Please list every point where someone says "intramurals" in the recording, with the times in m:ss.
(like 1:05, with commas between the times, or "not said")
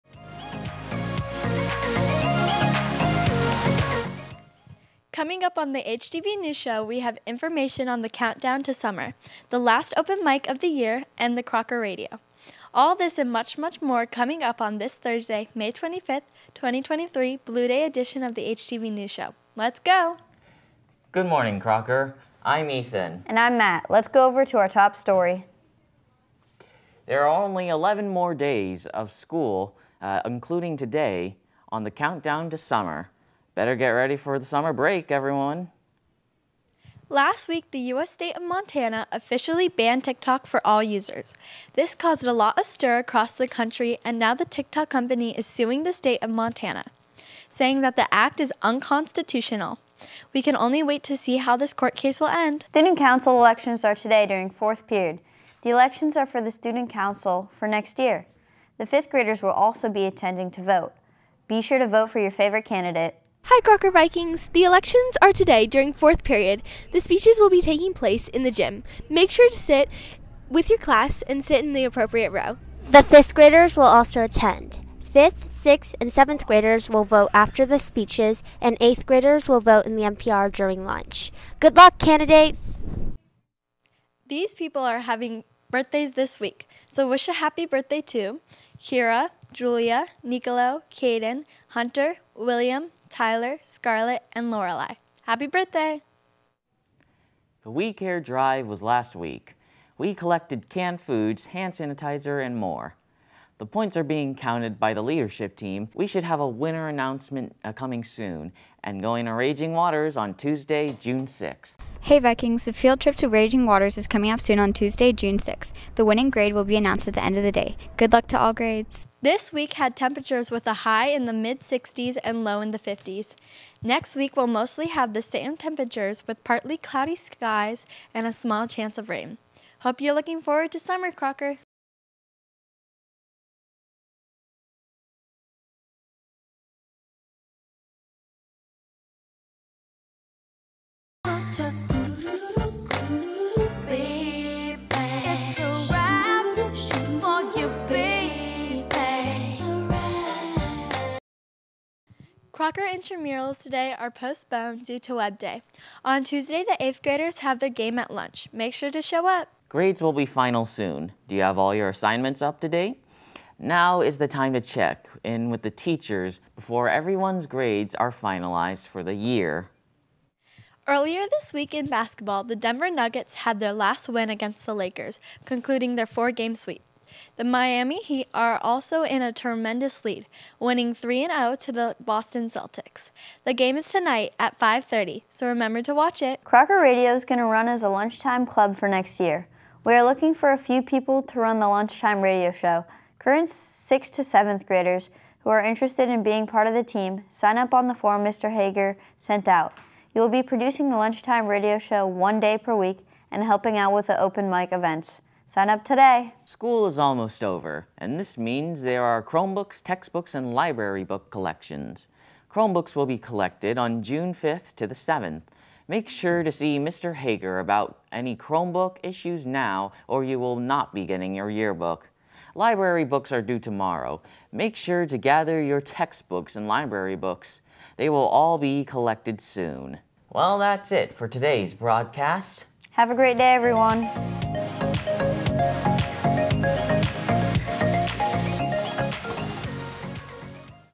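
2:32.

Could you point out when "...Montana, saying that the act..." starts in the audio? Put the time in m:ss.
0:46.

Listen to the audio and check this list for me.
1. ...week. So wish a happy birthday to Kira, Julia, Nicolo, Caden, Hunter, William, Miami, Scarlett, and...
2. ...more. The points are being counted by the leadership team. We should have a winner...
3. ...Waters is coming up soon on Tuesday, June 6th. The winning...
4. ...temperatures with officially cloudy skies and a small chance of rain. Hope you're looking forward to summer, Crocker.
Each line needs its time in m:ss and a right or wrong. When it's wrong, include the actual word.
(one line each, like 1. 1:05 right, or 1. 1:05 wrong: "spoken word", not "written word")
1. 1:26 wrong: "Tyler", not "Miami"
2. 1:42 right
3. 1:53 right
4. 2:05 wrong: "partly", not "officially".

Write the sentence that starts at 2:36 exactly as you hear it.
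On Tuesday, the 8th graders have their game at lunch.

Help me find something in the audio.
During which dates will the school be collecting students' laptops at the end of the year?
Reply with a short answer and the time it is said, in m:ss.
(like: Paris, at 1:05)
June 5th to the 7th, at 3:34.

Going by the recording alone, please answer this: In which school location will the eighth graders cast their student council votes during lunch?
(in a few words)
MPR.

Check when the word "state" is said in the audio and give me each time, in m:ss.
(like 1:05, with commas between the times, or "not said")
0:38, 0:45.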